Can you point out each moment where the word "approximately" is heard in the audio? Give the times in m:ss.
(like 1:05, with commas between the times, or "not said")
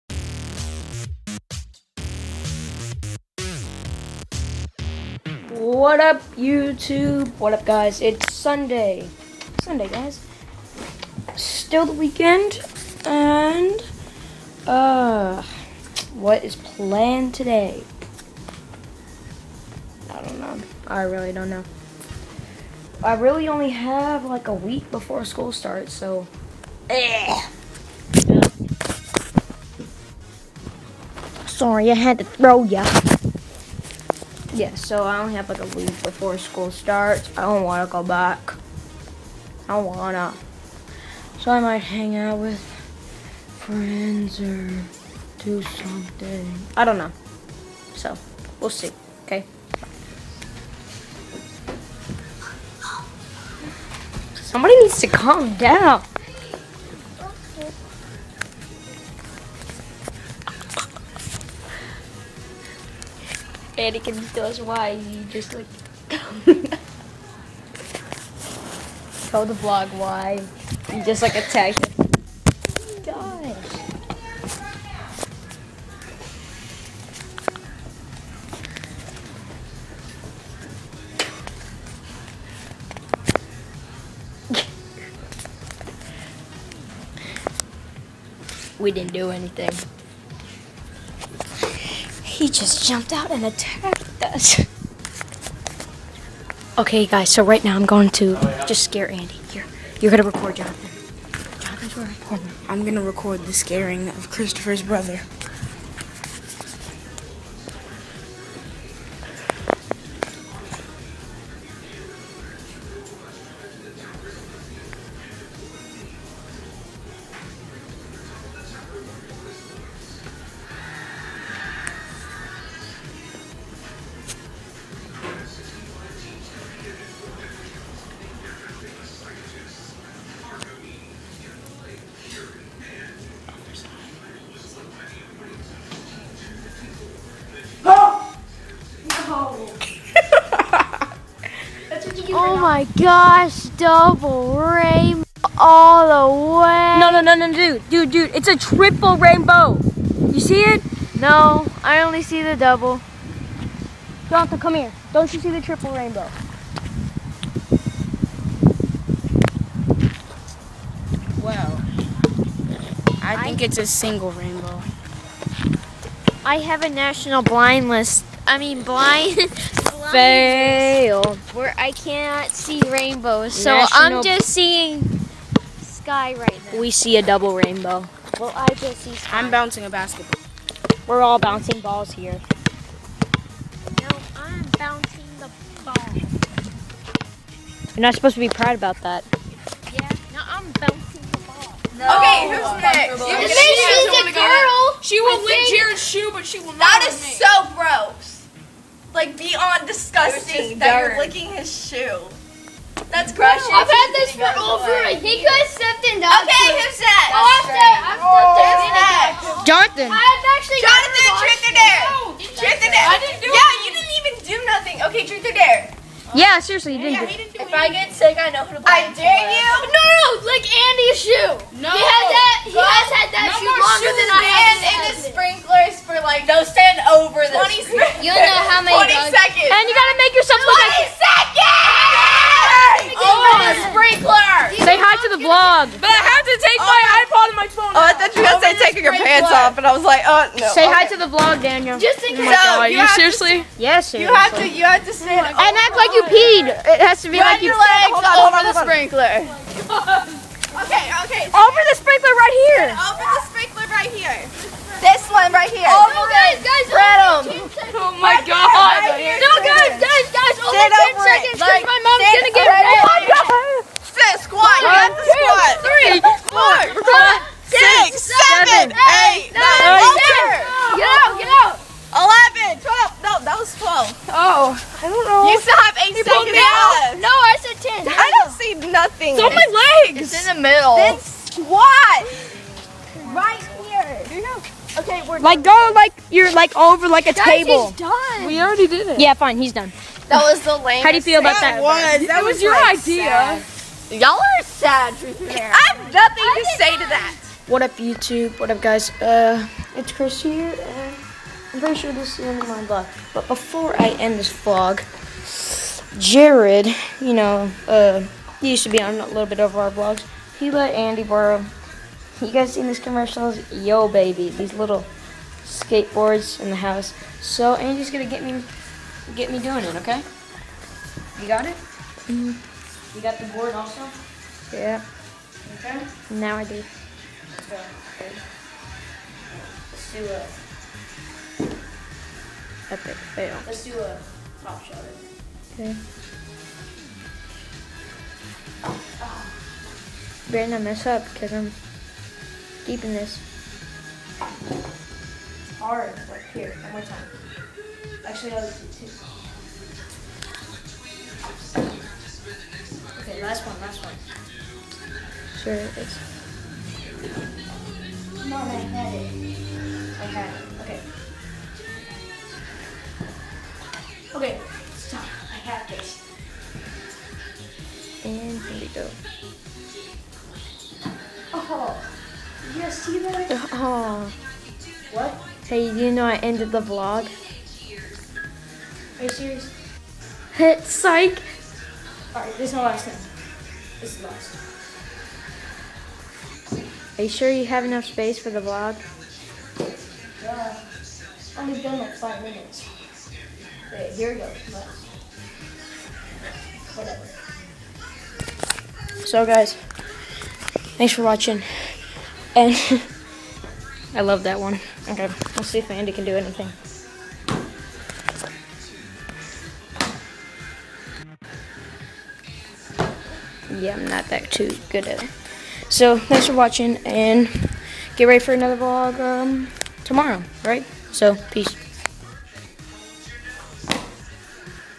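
not said.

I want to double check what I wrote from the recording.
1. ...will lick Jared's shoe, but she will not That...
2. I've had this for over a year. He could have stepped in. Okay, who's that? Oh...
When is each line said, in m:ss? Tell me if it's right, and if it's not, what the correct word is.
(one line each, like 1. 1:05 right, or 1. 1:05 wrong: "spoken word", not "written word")
1. 3:15 right
2. 3:23 right.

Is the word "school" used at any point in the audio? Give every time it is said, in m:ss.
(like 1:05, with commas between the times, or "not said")
0:25, 0:36.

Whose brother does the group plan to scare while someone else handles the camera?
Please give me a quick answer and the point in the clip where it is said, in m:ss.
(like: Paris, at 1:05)
Christopher's, at 1:44.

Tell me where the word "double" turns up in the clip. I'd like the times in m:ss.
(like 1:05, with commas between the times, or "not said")
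2:23, 2:32, 2:57.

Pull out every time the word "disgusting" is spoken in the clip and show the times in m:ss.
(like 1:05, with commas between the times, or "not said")
3:19.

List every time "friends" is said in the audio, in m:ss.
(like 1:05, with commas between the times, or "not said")
0:43.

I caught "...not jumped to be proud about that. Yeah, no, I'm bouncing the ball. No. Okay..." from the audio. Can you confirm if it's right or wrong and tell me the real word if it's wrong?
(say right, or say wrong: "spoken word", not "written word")
wrong: "supposed", not "jumped".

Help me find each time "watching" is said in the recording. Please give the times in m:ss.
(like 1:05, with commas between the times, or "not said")
6:41, 6:56.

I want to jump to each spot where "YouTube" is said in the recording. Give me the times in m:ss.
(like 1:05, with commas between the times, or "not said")
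0:06, 4:57.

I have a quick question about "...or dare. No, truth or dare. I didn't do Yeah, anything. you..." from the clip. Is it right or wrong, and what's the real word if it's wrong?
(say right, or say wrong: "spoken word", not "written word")
right.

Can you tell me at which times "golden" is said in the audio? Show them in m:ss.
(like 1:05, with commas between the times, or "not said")
not said.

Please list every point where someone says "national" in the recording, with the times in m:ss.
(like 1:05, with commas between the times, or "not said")
2:46, 2:53.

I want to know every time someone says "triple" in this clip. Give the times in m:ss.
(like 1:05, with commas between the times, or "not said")
2:28, 2:35.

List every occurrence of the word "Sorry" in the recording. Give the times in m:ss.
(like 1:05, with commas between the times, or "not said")
0:31.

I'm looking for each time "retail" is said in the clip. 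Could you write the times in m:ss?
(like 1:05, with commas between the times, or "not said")
not said.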